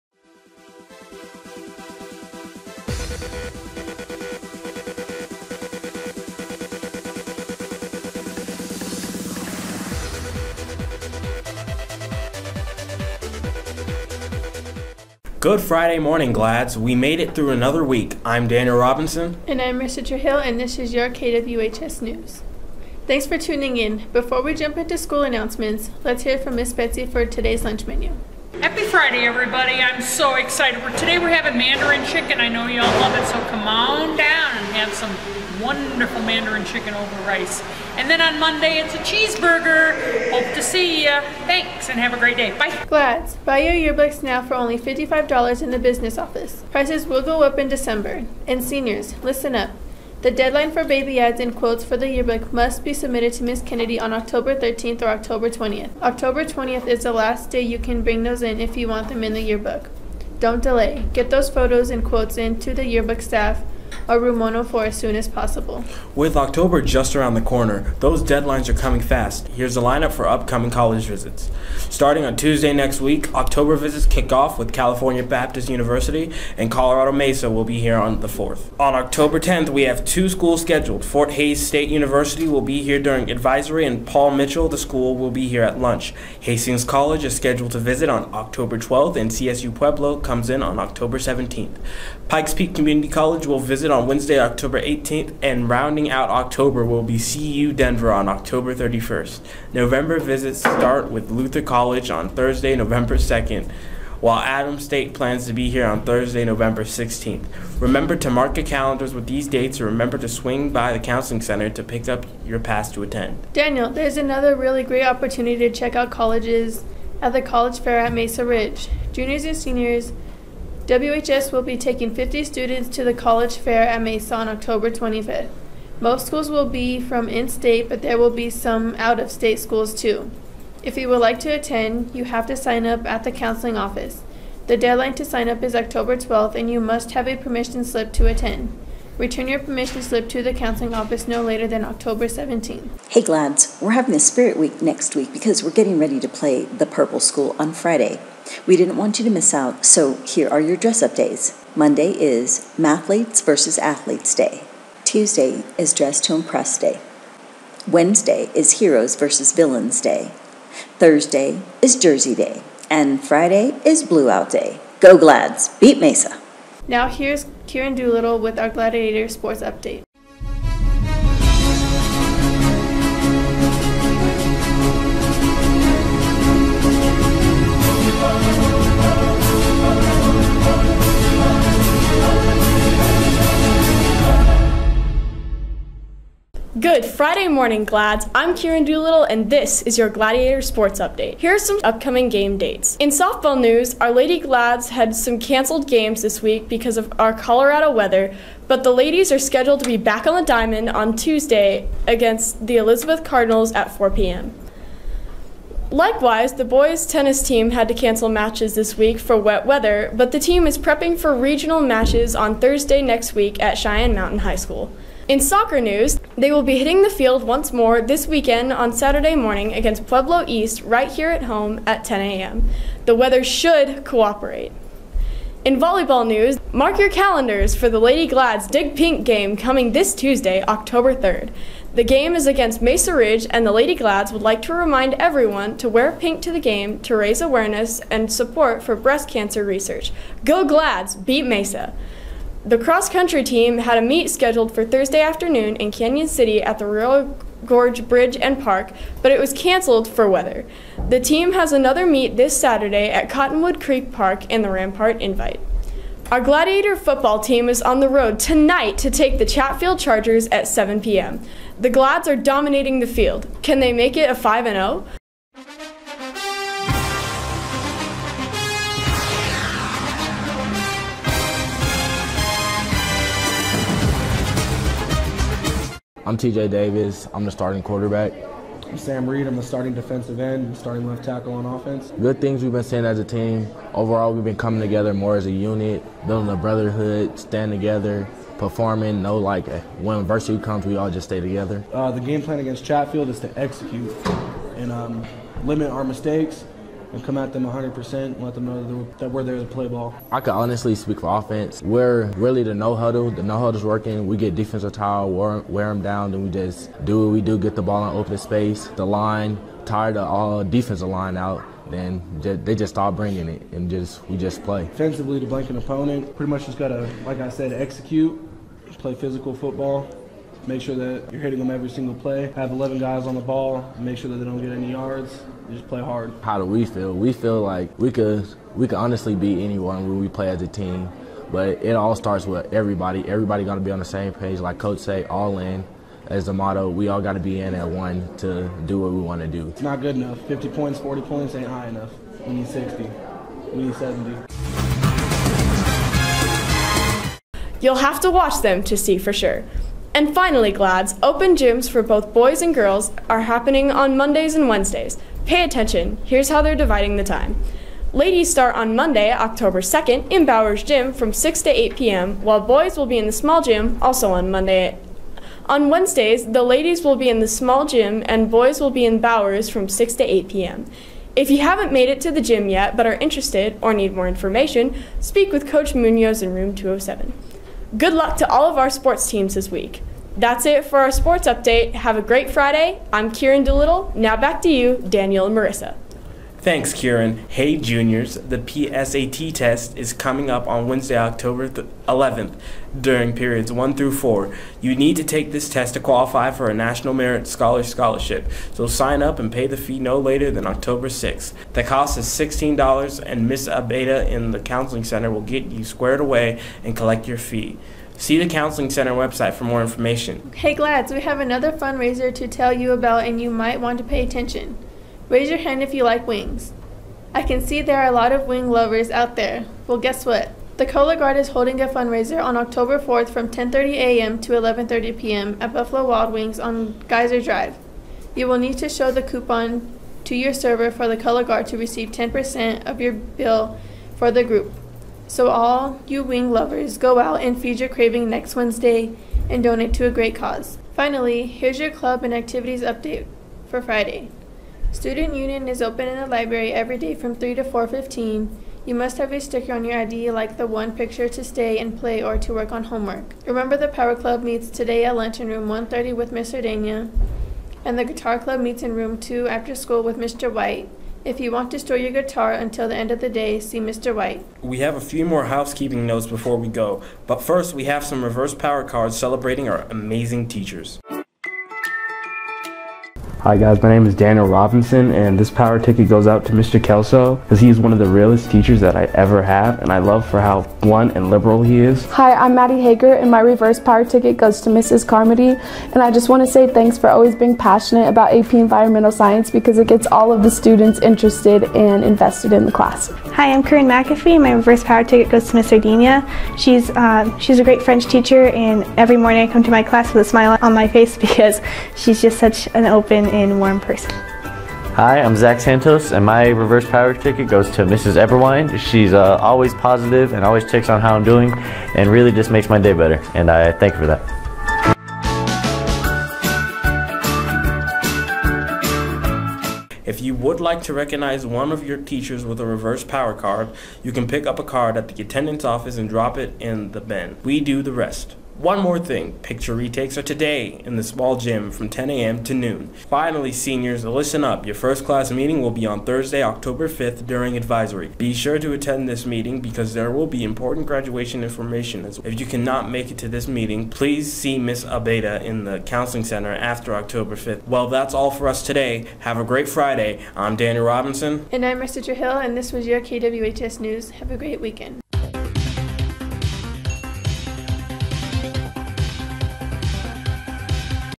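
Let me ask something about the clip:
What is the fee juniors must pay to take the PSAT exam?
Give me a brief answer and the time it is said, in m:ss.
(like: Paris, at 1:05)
$16, at 6:42.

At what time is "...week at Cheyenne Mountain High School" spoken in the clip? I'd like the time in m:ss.
3:33.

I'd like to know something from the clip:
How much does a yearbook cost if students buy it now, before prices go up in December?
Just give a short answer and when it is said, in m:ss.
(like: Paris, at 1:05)
$55, at 0:44.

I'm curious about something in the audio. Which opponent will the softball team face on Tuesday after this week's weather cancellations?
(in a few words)
Elizabeth Cardinals.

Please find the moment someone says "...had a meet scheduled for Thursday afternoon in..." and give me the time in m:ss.
4:03.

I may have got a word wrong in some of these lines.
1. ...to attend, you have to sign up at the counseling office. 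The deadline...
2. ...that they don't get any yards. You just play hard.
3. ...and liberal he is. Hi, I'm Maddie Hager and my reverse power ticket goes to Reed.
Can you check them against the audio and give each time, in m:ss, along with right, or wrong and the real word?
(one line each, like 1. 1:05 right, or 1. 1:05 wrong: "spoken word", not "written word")
1. 2:11 right
2. 5:24 right
3. 8:01 wrong: "Mrs", not "Reed".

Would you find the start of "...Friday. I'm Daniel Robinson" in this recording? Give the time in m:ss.
9:09.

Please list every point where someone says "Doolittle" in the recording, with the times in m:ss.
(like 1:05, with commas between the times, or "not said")
2:47, 3:08, 6:23.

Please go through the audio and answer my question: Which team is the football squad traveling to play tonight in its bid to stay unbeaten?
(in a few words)
Chatfield Chargers.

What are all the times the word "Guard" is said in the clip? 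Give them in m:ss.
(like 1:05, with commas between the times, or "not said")
7:01, 7:11.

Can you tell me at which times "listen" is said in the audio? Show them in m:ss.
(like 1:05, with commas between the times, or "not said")
0:49, 8:54.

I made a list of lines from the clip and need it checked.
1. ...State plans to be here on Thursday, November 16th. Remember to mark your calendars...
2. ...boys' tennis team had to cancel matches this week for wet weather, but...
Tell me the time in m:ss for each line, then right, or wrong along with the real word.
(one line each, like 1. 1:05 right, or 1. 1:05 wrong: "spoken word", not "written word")
1. 1:44 right
2. 3:26 right.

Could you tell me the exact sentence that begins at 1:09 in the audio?
Here's a lineup for upcoming college visits.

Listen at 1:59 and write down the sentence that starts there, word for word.
Juniors and seniors, WHS will be taking 50 students to the college fair at Mesa on October 25th.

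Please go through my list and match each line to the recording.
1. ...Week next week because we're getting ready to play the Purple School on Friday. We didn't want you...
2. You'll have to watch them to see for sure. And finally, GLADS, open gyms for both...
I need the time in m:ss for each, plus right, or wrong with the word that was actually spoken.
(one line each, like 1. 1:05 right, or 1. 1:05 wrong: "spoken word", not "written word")
1. 2:24 right
2. 5:47 right.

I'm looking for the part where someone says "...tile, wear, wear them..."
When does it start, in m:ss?
5:04.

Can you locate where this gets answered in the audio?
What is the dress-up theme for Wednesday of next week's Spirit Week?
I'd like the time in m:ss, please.
2:38.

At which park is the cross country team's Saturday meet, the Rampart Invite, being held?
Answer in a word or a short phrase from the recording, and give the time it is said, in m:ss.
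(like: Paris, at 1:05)
Cottonwood Creek Park, at 4:13.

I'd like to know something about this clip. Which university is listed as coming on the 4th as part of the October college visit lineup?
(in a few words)
Colorado Mesa.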